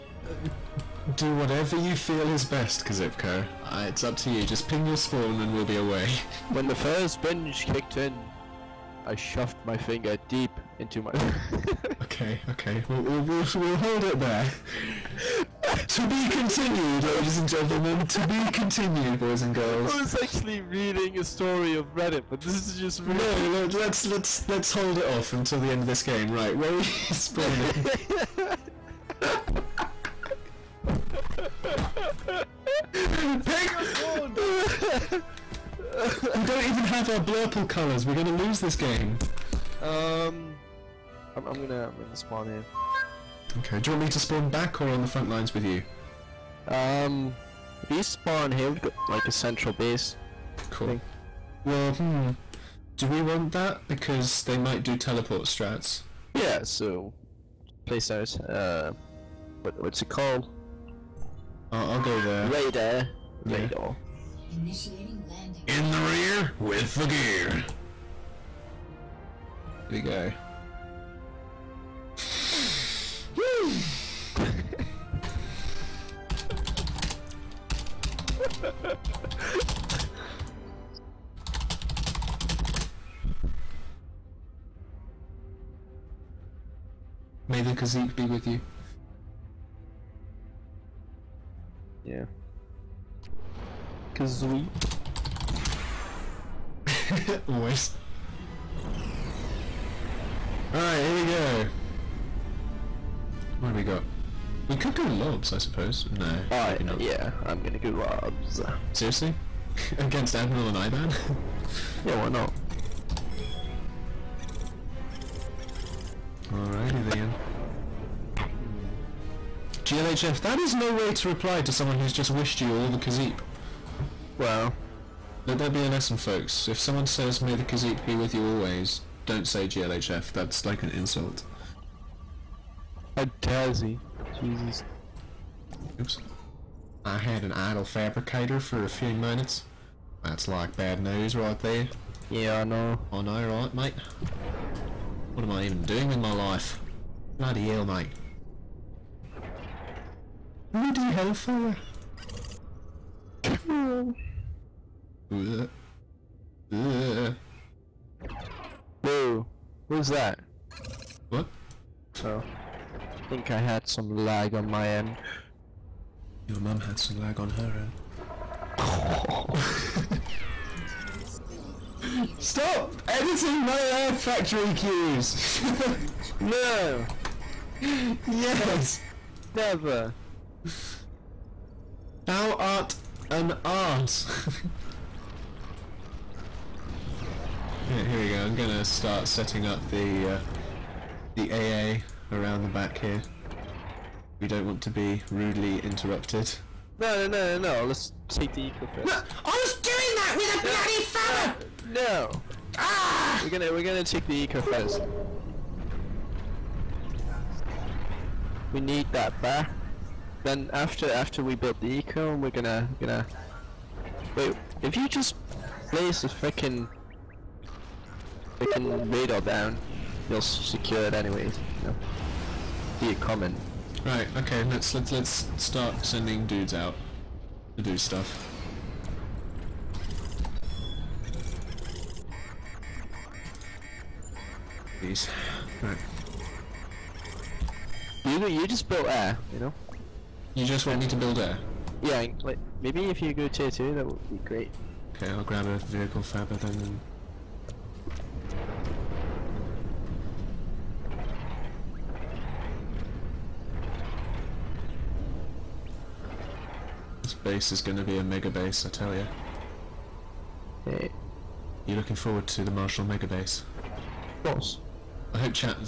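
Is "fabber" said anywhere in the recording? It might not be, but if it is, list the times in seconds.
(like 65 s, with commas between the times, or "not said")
201 s, 246 s.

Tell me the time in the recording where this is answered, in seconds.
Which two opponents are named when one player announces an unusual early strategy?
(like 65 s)
110 s.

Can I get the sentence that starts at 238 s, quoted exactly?
You you just built air, you know.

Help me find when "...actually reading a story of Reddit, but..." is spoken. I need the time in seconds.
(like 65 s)
20 s.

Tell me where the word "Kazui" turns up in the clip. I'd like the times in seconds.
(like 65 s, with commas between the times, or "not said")
94 s.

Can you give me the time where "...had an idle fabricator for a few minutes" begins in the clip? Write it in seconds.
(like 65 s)
137 s.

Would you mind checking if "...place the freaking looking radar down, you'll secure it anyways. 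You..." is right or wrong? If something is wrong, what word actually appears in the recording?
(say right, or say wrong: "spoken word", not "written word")
wrong: "freaking", not "looking".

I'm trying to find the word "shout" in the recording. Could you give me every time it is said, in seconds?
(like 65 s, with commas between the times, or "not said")
not said.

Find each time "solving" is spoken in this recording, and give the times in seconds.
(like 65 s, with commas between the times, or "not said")
not said.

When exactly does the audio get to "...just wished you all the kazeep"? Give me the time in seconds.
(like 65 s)
122 s.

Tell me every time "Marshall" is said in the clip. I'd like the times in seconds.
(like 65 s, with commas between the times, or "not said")
262 s.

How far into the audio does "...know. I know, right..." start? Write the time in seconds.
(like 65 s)
142 s.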